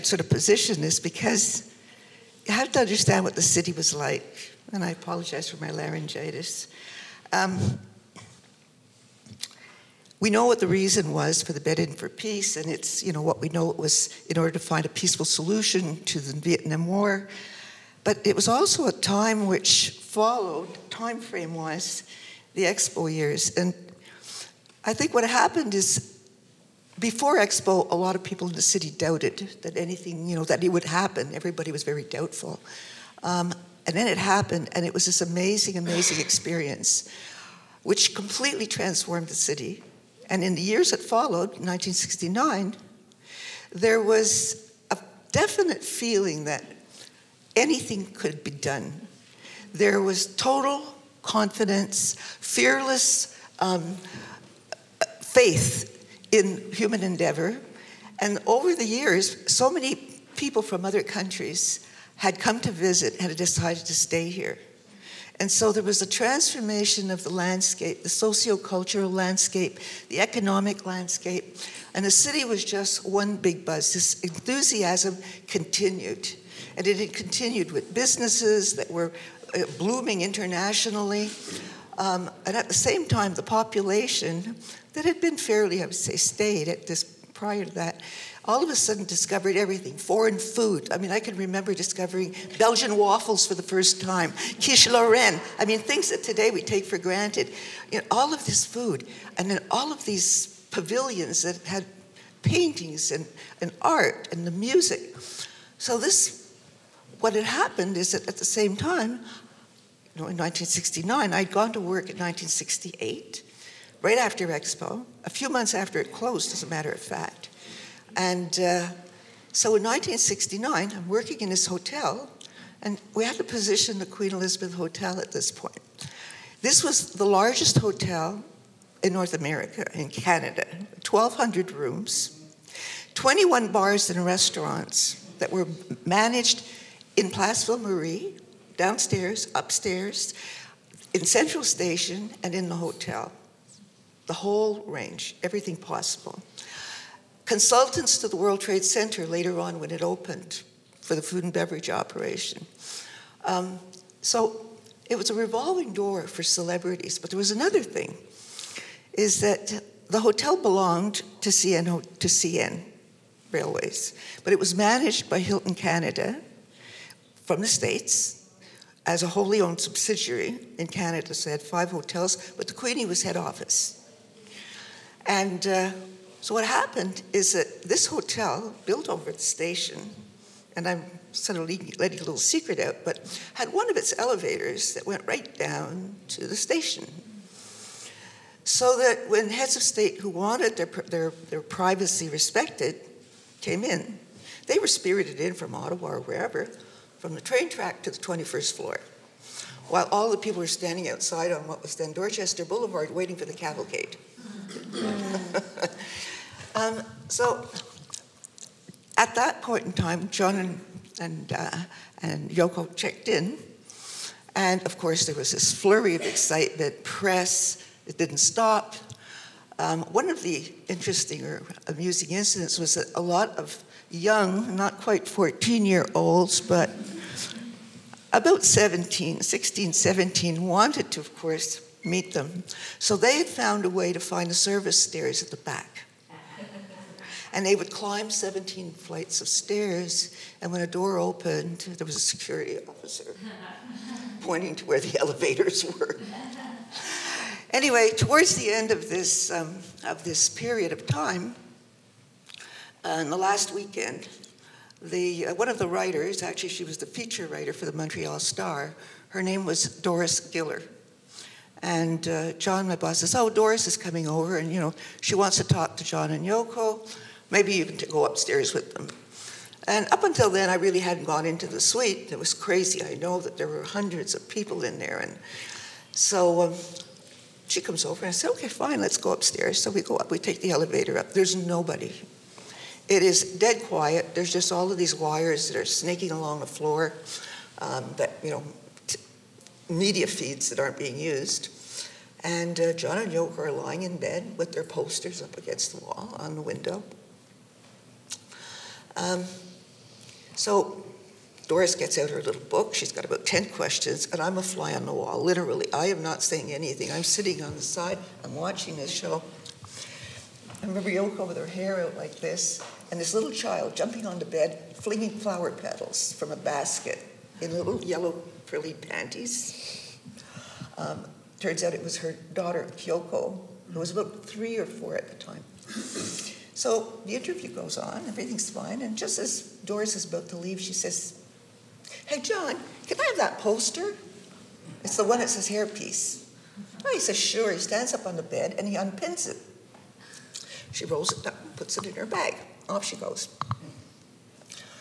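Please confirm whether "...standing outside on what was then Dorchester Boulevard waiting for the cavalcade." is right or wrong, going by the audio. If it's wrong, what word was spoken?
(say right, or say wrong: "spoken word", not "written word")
right.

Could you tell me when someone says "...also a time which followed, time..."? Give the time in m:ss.
0:18.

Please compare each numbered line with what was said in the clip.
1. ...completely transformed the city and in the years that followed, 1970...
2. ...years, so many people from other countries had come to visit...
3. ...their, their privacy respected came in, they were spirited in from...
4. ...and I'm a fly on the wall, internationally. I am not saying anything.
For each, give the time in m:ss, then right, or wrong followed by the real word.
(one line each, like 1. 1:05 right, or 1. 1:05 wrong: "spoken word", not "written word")
1. 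0:38 wrong: "1969", not "1970"
2. 0:58 right
3. 3:10 right
4. 5:04 wrong: "literally", not "internationally".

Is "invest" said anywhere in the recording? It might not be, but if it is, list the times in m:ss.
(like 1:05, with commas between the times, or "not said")
not said.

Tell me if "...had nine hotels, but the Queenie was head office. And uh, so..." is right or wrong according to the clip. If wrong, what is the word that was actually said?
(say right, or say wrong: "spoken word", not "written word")
wrong: "five", not "nine".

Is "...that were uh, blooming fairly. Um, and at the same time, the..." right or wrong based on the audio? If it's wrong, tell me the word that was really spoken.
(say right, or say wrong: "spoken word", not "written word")
wrong: "internationally", not "fairly".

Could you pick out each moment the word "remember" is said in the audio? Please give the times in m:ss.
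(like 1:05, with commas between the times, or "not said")
1:31, 5:10.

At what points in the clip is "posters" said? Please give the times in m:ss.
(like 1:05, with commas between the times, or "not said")
4:54, 5:33.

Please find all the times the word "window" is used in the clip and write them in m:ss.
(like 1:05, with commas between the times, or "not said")
4:56.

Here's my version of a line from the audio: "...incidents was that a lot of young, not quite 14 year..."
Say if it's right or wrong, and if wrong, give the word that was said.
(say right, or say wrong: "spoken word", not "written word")
right.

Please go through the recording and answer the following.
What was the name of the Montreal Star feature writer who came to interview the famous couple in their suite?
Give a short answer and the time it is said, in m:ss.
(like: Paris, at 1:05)
Doris Giller, at 4:19.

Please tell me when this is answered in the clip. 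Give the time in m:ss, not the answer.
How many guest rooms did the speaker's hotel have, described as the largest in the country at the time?
2:11.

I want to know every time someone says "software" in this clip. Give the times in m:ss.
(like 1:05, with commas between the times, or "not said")
not said.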